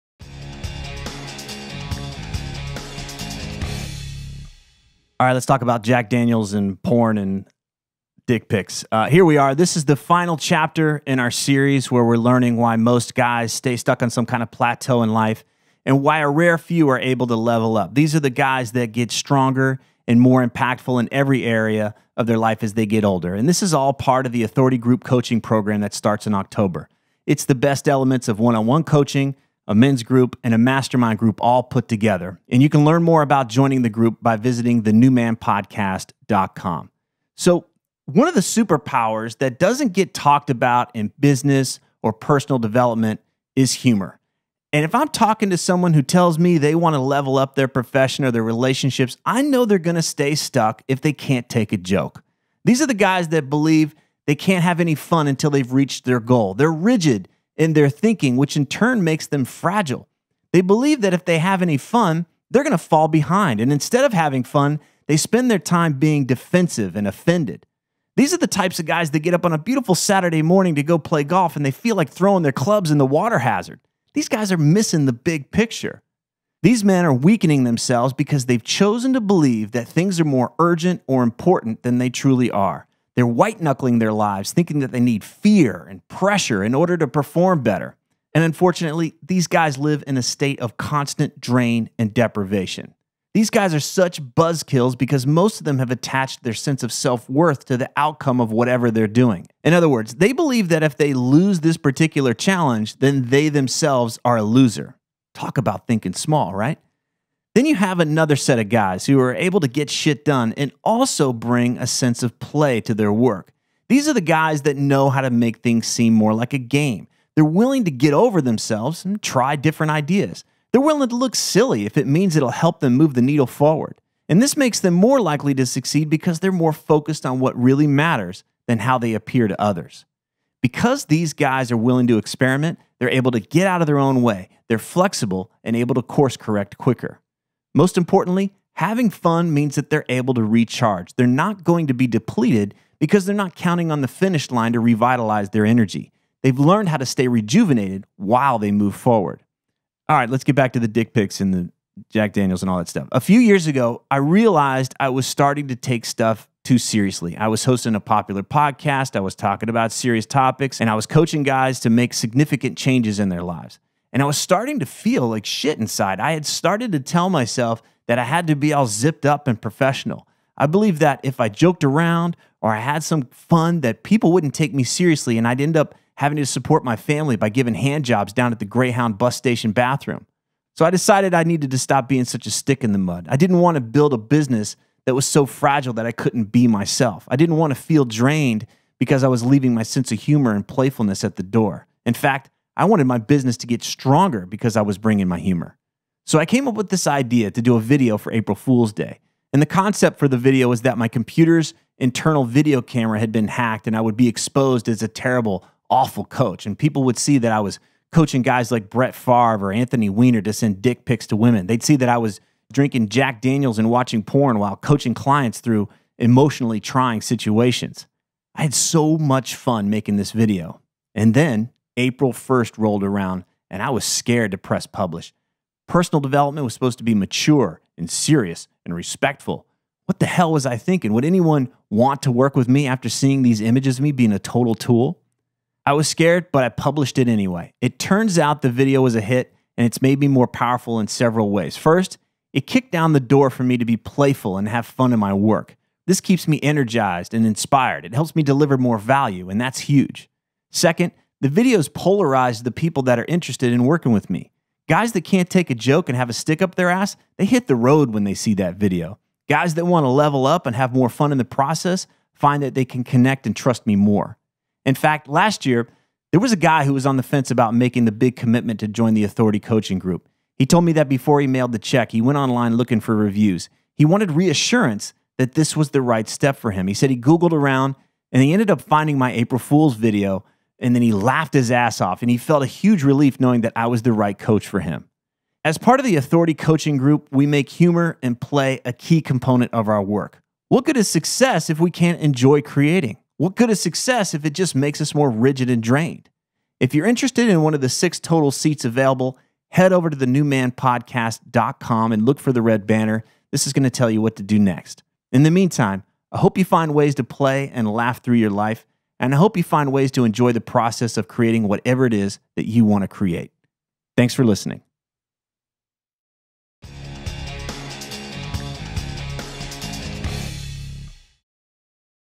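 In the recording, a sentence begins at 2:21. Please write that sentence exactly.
They're not going to be depleted because they're not counting on the finish line to revitalize their energy.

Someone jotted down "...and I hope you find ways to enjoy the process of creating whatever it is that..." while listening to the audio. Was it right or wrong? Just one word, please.
right.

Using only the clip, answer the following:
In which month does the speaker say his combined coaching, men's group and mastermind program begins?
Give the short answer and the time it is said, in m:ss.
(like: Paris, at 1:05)
October, at 0:26.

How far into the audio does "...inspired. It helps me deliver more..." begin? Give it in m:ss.
4:07.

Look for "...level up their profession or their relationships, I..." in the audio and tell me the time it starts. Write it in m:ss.
0:46.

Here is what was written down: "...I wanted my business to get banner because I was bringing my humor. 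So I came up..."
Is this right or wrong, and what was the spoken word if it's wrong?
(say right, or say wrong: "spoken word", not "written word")
wrong: "stronger", not "banner".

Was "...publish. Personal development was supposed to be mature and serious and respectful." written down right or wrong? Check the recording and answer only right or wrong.
right.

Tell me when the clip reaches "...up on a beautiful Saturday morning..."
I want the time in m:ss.
1:09.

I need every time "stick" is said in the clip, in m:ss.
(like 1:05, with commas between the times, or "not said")
3:02, 4:16.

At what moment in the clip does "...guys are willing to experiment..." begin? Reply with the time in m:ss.
2:11.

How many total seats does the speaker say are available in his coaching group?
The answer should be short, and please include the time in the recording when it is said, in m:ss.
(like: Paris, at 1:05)
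6, at 4:57.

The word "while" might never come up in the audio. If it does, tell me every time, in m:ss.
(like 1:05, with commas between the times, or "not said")
2:28, 3:34.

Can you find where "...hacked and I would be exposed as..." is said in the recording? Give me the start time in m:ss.
3:23.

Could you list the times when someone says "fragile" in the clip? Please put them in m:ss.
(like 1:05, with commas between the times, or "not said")
0:59, 3:05.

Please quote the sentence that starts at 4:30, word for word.
He told me that before he mailed the check, he went online looking for reviews.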